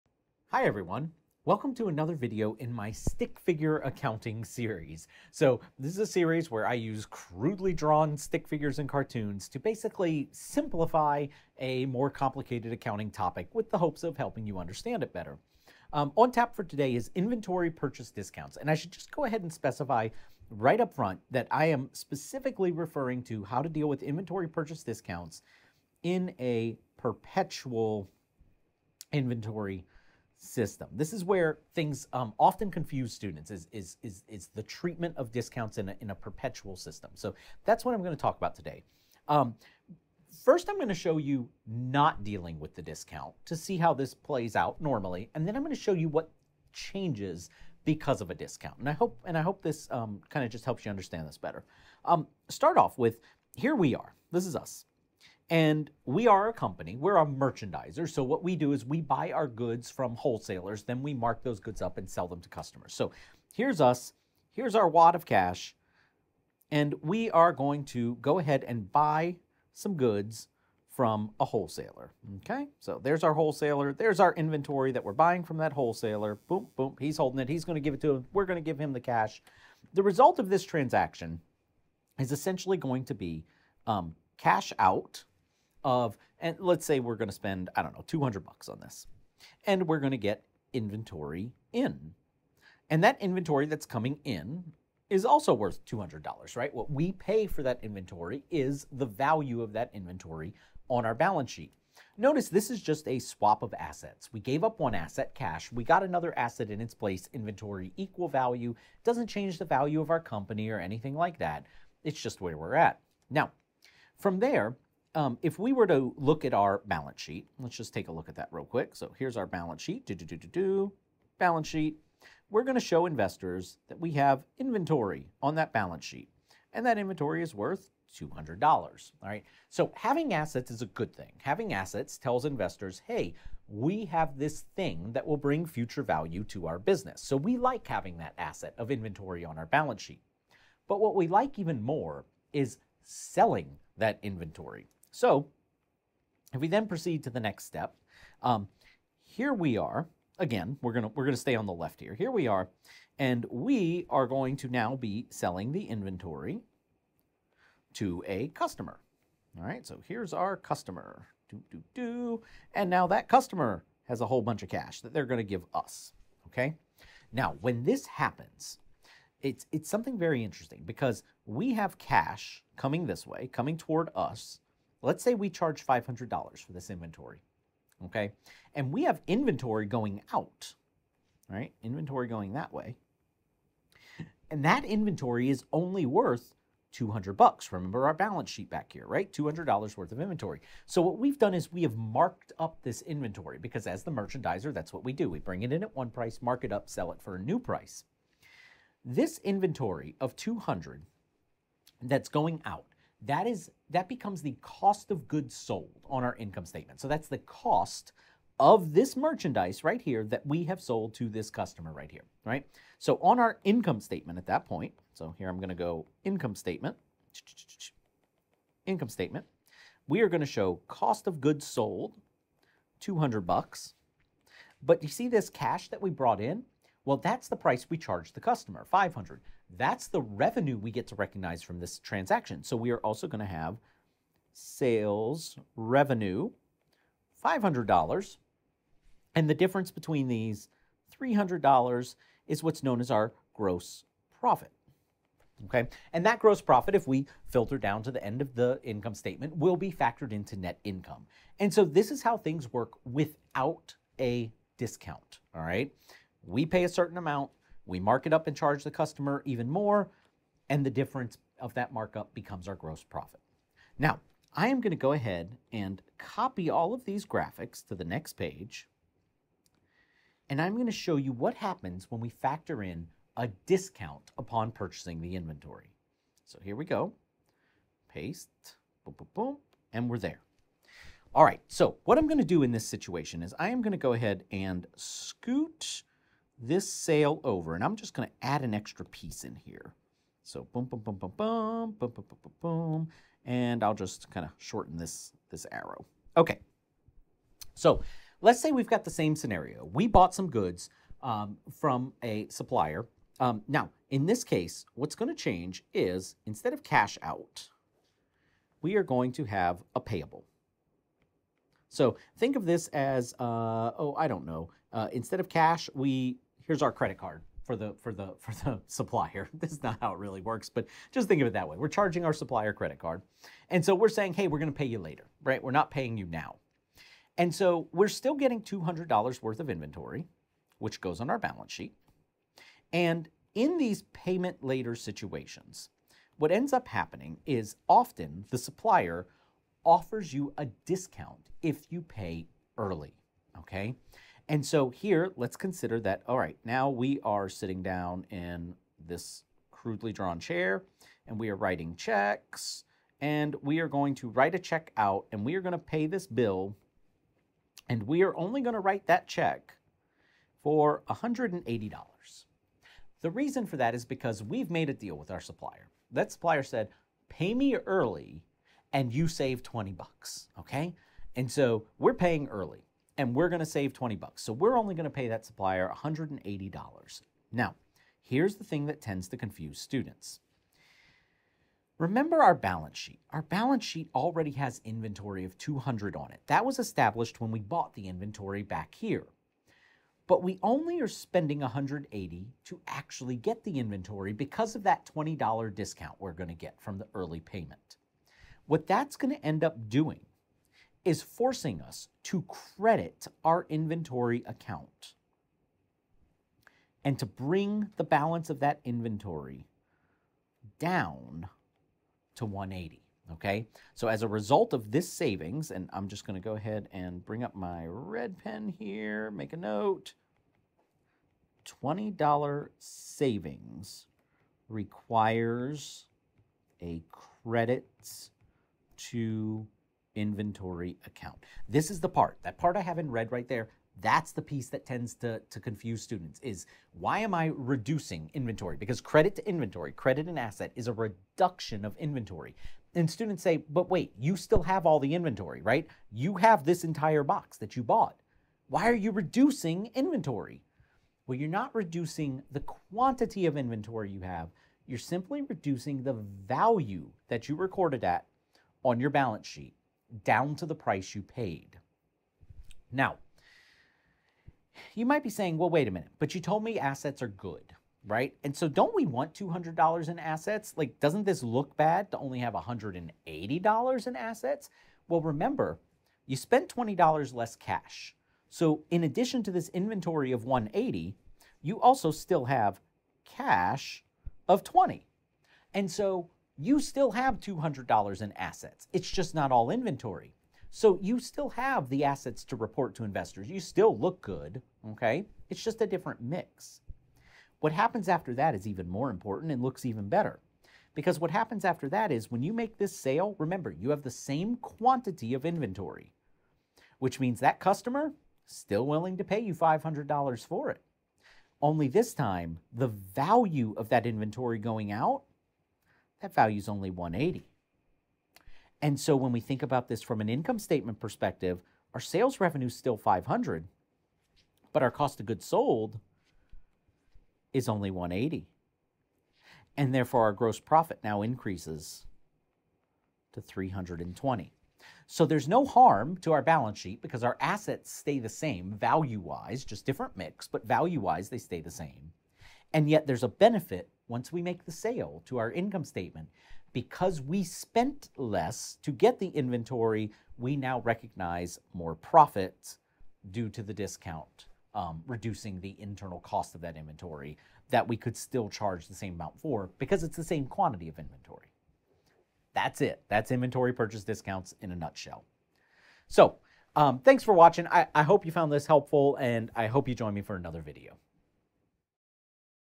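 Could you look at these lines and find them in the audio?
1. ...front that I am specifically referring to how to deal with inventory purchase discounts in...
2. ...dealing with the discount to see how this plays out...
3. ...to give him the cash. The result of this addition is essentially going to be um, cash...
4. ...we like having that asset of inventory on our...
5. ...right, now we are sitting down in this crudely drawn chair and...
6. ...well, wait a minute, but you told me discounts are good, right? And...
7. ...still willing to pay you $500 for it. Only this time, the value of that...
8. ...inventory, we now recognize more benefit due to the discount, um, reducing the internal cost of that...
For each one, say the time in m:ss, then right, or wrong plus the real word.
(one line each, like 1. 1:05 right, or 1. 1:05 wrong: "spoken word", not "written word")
1. 0:20 right
2. 0:42 right
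3. 1:18 wrong: "transaction", not "addition"
4. 2:17 right
5. 5:46 right
6. 7:45 wrong: "assets", not "discounts"
7. 8:28 right
8. 9:09 wrong: "profit", not "benefit".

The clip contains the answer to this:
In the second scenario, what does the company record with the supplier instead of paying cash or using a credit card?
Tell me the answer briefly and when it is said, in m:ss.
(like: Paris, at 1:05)
a payable, at 5:09.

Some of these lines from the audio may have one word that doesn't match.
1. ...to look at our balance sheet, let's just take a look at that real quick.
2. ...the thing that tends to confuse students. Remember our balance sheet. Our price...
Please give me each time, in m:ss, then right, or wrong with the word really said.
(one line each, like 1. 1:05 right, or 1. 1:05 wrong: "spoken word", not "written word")
1. 1:55 right
2. 6:18 wrong: "balance", not "price".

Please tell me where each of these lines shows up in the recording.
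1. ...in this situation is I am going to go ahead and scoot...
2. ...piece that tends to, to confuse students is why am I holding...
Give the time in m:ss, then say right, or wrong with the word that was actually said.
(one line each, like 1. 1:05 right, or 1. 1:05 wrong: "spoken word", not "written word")
1. 4:42 right
2. 7:14 wrong: "reducing", not "holding".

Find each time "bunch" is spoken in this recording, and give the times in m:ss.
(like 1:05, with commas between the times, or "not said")
2:44.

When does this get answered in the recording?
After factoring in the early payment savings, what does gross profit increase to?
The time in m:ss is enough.
8:53.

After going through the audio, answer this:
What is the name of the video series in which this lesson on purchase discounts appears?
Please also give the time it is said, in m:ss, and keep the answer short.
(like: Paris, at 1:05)
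stick figure accounting, at 0:02.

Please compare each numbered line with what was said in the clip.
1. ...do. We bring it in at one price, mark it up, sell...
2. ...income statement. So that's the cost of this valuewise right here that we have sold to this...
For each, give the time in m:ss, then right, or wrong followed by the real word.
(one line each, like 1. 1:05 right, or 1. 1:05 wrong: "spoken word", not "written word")
1. 3:15 right
2. 3:26 wrong: "merchandise", not "valuewise".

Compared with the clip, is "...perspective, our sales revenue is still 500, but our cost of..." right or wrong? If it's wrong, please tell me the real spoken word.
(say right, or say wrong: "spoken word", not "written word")
right.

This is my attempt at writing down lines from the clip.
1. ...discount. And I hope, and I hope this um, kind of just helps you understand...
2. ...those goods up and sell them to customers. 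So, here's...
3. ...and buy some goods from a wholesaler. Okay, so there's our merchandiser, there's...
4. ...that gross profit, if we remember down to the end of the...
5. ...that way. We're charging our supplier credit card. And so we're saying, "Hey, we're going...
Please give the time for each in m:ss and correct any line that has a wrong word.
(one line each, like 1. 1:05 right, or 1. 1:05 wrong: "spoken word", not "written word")
1. 0:48 right
2. 1:01 right
3. 1:08 wrong: "wholesaler", not "merchandiser"
4. 4:06 wrong: "filter", not "remember"
5. 5:21 right.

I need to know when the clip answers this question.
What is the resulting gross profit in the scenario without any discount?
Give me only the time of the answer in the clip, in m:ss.
4:01.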